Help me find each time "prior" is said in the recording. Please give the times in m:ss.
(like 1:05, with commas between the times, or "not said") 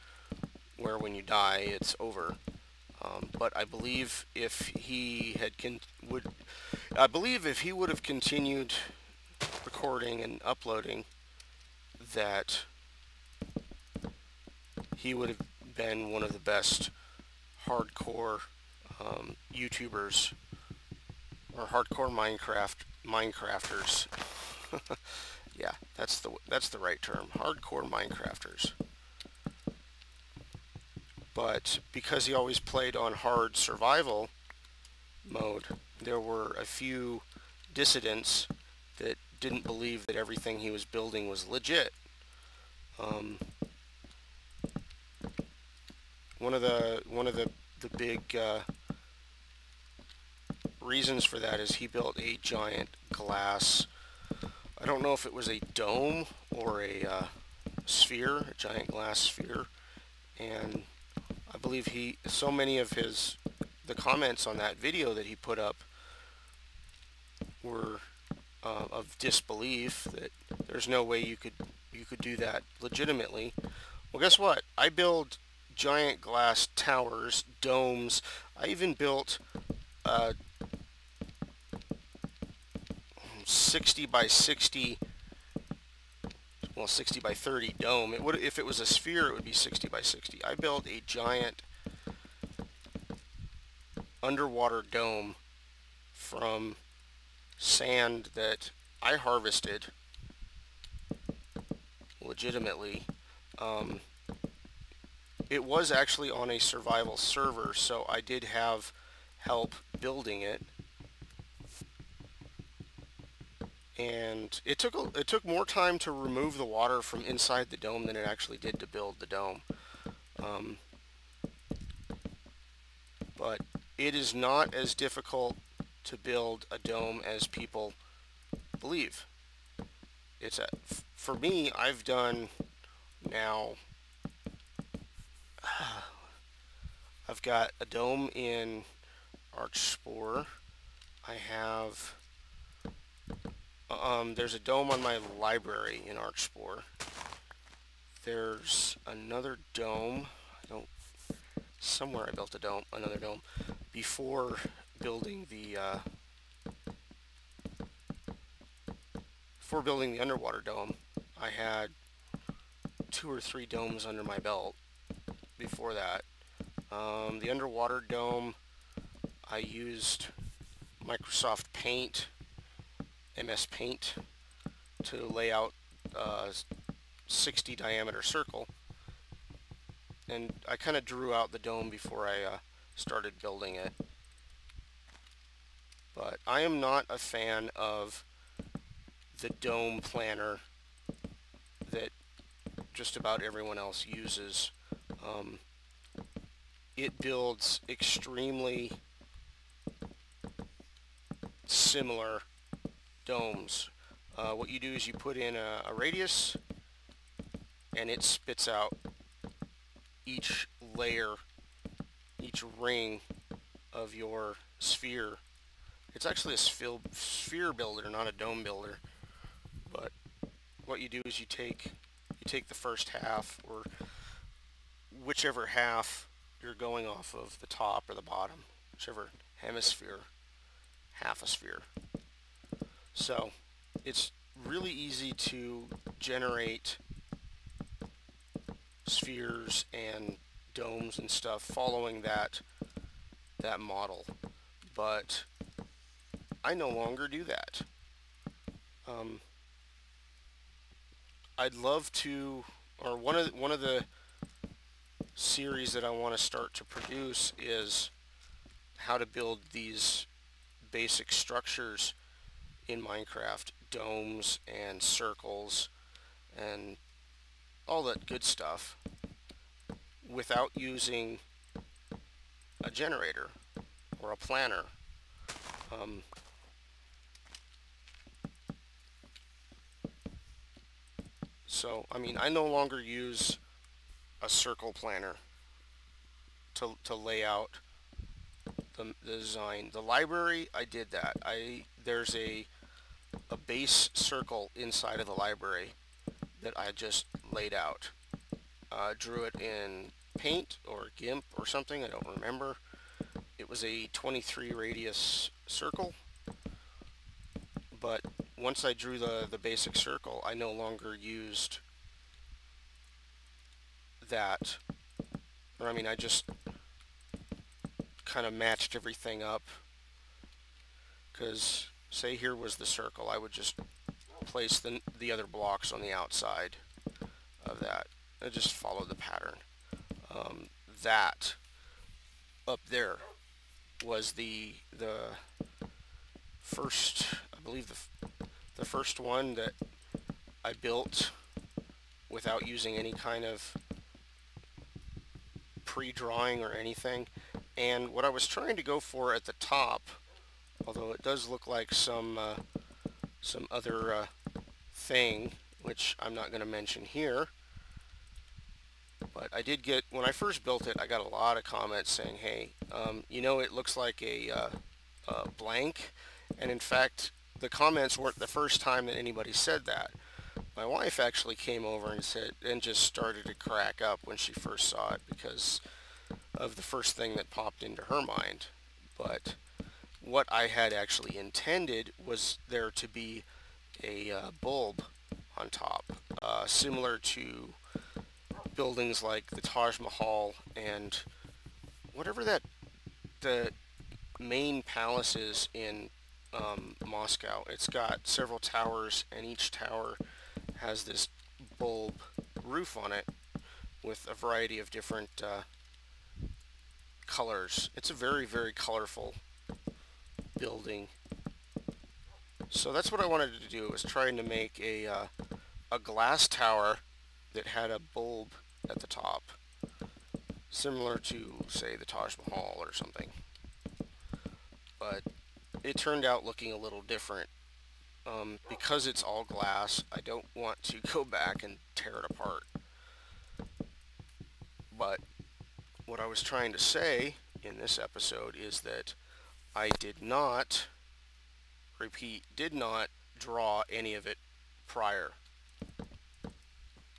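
7:24.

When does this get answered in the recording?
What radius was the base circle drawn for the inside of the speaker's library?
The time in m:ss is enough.
5:04.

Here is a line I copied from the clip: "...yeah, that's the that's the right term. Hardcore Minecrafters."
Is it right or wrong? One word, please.
right.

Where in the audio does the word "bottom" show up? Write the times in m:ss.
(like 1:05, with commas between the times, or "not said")
3:48.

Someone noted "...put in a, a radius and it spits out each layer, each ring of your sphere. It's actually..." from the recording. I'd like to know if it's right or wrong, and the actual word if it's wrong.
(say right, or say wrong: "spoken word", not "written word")
right.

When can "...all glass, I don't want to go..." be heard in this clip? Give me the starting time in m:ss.
7:09.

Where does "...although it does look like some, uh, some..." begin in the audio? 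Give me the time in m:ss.
5:50.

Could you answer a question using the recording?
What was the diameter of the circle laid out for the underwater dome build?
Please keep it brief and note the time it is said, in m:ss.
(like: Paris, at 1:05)
60, at 2:57.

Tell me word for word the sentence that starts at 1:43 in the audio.
Um, it was actually on a survival server, so I did have help building it.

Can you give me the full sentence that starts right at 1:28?
It would, if it was a sphere, it would be 60 by 60.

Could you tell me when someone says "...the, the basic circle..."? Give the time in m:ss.
5:09.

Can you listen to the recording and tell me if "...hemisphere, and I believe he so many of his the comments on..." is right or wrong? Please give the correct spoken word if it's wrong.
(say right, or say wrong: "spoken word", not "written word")
wrong: "sphere", not "hemisphere".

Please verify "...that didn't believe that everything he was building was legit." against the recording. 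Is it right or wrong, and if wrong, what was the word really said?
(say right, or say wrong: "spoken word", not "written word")
right.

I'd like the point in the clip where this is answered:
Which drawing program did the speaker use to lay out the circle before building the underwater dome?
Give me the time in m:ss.
2:53.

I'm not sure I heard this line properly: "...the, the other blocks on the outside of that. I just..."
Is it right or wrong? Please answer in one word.
right.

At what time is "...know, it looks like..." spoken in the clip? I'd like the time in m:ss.
6:03.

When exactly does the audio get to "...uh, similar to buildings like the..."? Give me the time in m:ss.
6:26.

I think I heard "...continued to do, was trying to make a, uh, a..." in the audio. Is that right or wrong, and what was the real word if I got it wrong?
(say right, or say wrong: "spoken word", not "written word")
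wrong: "wanted", not "continued".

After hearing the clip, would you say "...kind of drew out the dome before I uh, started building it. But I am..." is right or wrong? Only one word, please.
right.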